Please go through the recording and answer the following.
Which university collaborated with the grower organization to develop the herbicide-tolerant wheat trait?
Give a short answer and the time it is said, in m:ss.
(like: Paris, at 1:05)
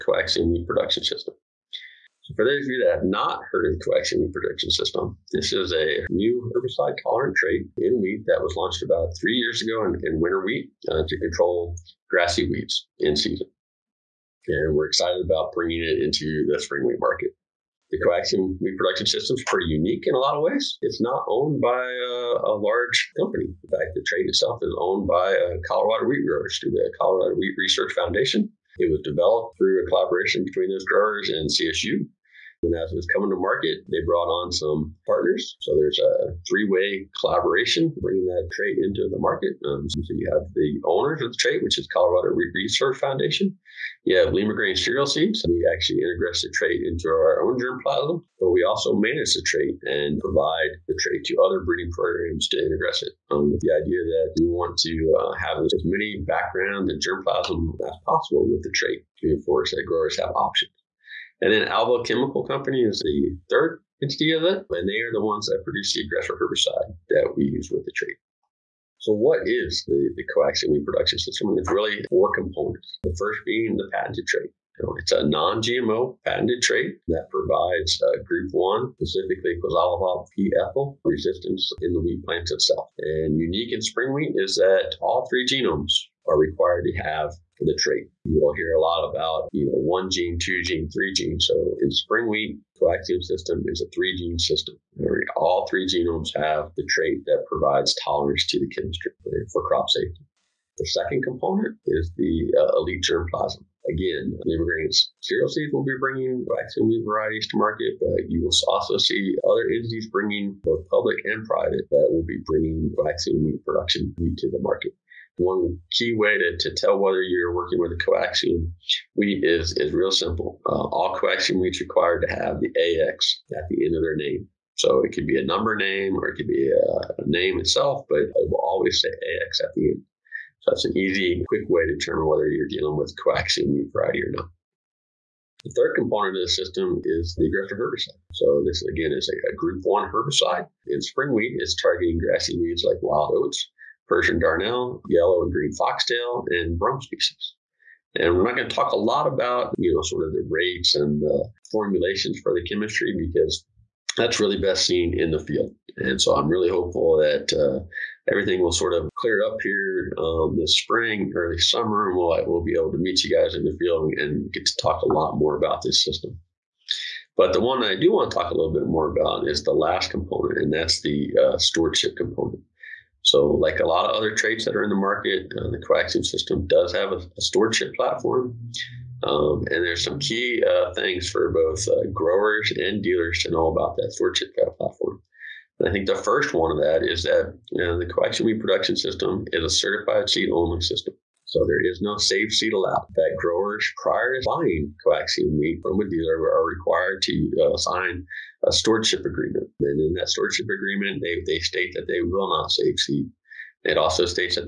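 CSU, at 0:31.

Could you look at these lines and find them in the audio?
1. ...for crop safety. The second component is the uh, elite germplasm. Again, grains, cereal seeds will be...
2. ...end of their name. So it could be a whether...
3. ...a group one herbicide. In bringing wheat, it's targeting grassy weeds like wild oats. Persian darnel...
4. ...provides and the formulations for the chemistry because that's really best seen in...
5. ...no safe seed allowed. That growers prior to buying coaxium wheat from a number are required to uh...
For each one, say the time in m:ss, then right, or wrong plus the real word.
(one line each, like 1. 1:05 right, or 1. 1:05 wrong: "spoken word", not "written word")
1. 1:39 right
2. 2:03 wrong: "number", not "whether"
3. 2:19 wrong: "spring", not "bringing"
4. 2:30 wrong: "rates", not "provides"
5. 3:12 wrong: "dealer", not "number".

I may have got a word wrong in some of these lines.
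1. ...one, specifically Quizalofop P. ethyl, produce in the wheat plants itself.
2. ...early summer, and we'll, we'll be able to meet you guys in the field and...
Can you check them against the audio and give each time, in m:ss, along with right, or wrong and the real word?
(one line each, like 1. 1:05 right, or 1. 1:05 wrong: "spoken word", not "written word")
1. 1:18 wrong: "resistance", not "produce"
2. 2:41 right.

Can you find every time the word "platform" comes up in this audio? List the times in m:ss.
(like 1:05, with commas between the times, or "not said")
2:57, 3:04.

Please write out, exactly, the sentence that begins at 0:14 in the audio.
And we're excited about bringing it into the spring wheat market.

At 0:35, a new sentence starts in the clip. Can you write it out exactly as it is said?
So there's a three way collaboration bringing that trait into the market.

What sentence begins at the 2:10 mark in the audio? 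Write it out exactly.
So that's an easy, quick way to determine whether you're dealing with coaxium weed variety or not.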